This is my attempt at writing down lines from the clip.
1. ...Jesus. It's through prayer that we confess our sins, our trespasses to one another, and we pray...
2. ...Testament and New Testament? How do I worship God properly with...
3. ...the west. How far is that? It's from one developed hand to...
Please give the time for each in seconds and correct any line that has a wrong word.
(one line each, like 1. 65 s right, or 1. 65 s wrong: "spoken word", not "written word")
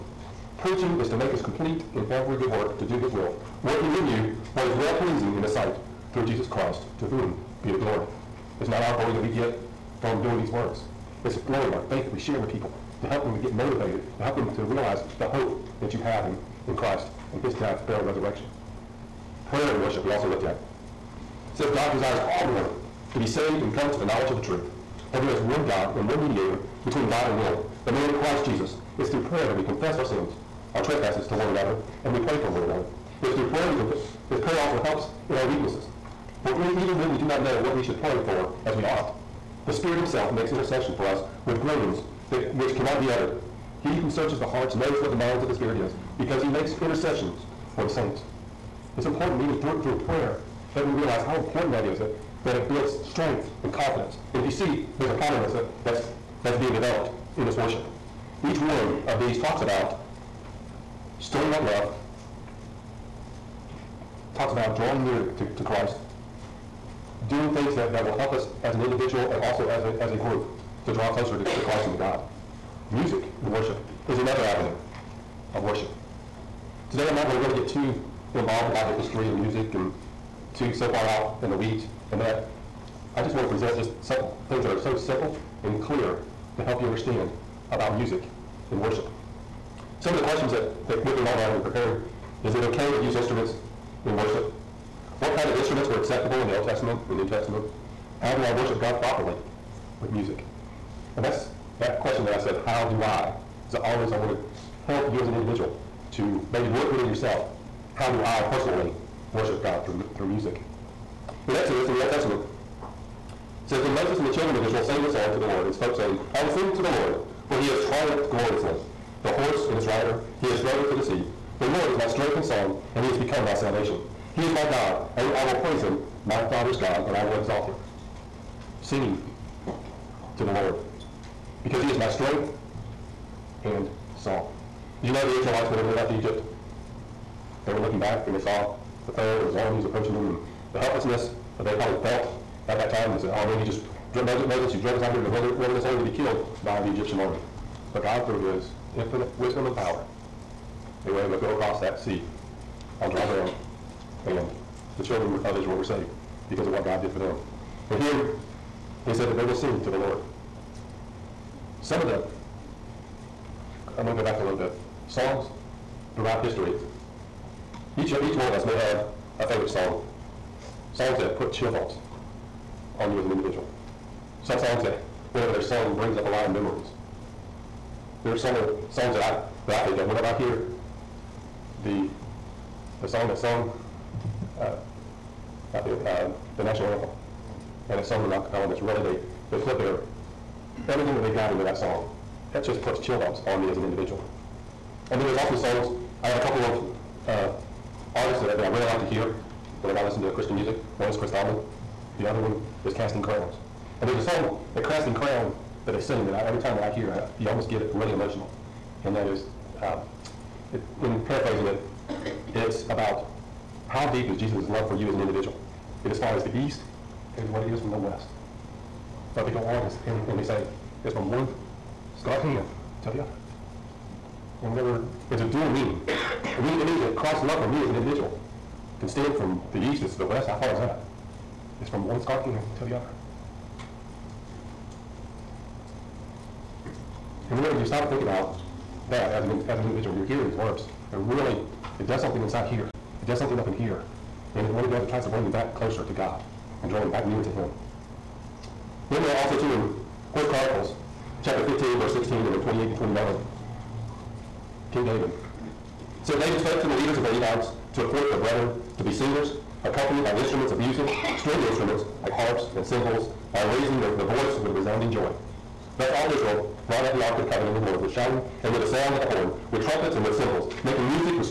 1. 28 s right
2. 96 s right
3. 230 s wrong: "scarred", not "developed".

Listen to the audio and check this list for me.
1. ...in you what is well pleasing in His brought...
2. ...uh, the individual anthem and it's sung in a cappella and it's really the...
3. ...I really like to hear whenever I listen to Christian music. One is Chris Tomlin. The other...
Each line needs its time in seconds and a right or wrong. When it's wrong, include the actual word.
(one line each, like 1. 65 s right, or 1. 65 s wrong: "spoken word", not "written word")
1. 3 s wrong: "sight", not "brought"
2. 186 s wrong: "national", not "individual"
3. 198 s right.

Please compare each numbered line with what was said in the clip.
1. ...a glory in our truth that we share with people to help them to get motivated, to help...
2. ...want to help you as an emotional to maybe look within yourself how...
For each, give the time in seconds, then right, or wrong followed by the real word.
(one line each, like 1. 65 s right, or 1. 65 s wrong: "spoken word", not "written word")
1. 11 s wrong: "faith", not "truth"
2. 104 s wrong: "individual", not "emotional".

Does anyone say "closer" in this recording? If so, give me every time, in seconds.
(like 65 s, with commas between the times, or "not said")
71 s, 245 s.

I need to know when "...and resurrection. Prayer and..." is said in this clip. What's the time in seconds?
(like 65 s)
18 s.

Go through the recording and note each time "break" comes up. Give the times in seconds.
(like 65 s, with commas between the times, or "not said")
not said.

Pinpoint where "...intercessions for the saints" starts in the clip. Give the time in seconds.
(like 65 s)
46 s.